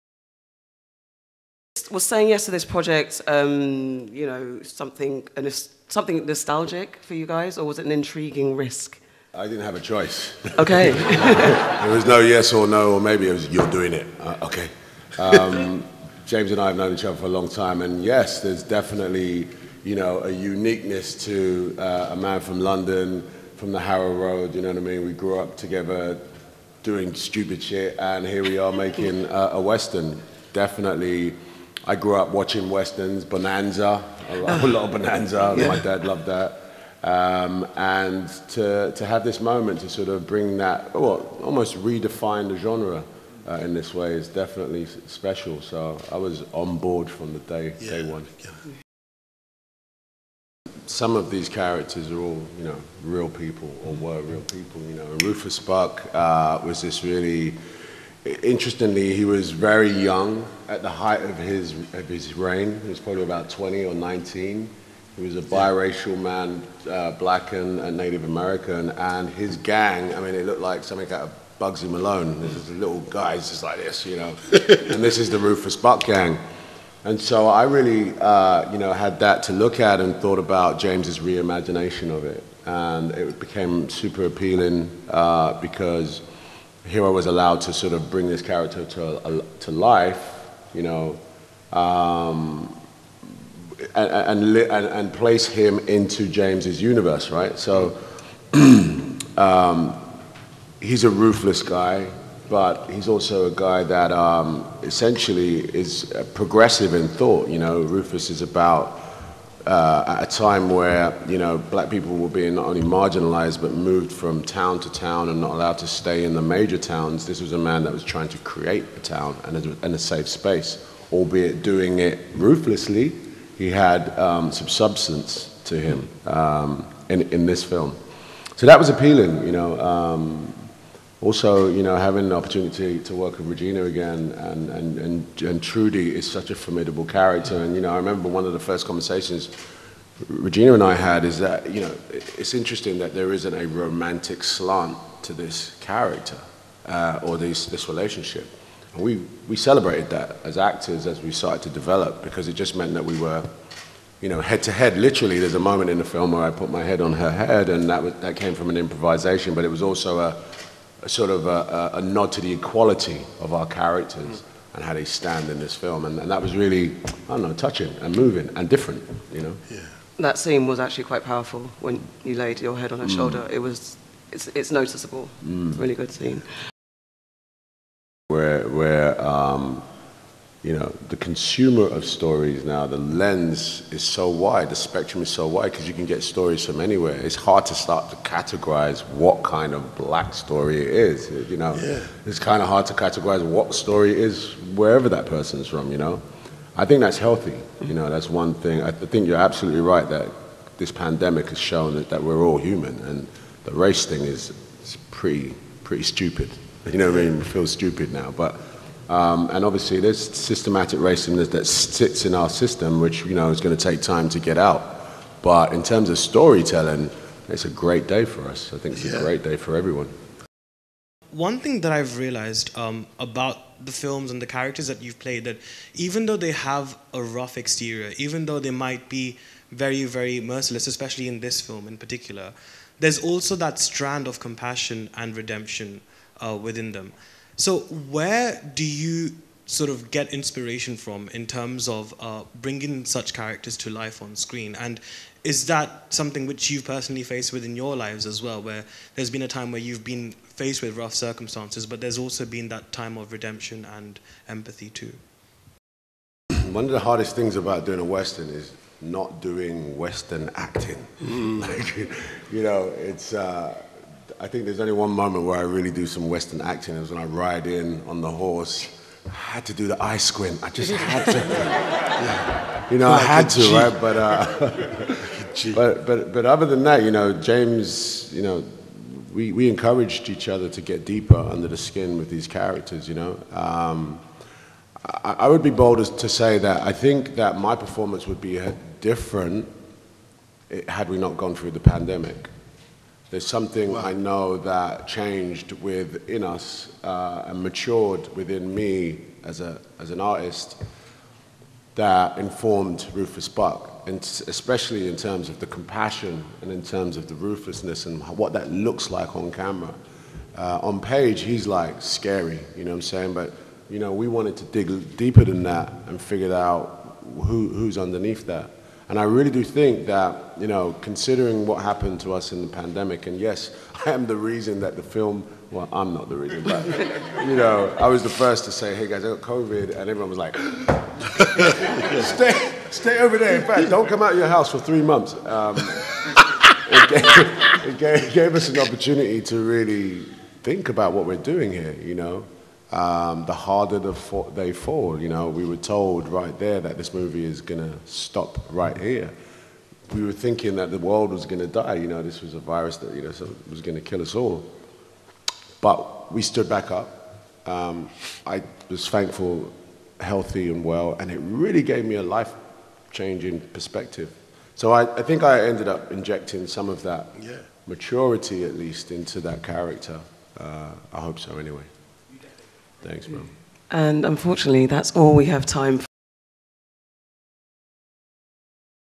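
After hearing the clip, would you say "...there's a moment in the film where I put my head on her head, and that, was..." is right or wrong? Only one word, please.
right.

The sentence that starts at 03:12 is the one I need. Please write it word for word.
it's kind of hard to categorize what story it is wherever that person's from.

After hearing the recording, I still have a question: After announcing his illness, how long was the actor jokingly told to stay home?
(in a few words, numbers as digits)
3 months.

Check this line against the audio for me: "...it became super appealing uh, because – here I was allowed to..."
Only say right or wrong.
right.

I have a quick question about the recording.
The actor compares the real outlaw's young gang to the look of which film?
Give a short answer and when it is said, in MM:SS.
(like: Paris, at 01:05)
Bugsy Malone, at 01:11.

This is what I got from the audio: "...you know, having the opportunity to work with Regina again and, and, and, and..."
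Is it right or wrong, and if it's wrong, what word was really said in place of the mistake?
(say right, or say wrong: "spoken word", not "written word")
right.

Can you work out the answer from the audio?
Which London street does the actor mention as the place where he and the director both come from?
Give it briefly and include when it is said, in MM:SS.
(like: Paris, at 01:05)
Harrow Road, at 00:23.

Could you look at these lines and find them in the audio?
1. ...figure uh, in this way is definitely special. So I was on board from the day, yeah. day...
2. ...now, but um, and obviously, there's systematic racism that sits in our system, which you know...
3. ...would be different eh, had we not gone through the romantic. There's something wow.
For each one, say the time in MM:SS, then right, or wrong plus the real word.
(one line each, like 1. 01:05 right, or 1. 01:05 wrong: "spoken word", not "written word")
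1. 00:42 wrong: "genre", not "figure"
2. 03:28 right
3. 04:48 wrong: "pandemic", not "romantic".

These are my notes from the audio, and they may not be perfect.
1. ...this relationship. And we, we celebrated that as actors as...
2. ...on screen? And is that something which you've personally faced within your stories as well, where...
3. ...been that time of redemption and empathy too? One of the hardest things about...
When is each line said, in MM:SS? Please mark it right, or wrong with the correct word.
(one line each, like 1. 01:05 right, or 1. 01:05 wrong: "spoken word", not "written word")
1. 02:27 right
2. 04:04 wrong: "lives", not "stories"
3. 04:12 right.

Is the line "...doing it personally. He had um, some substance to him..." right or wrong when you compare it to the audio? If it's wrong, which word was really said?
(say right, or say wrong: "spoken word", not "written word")
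wrong: "ruthlessly", not "personally".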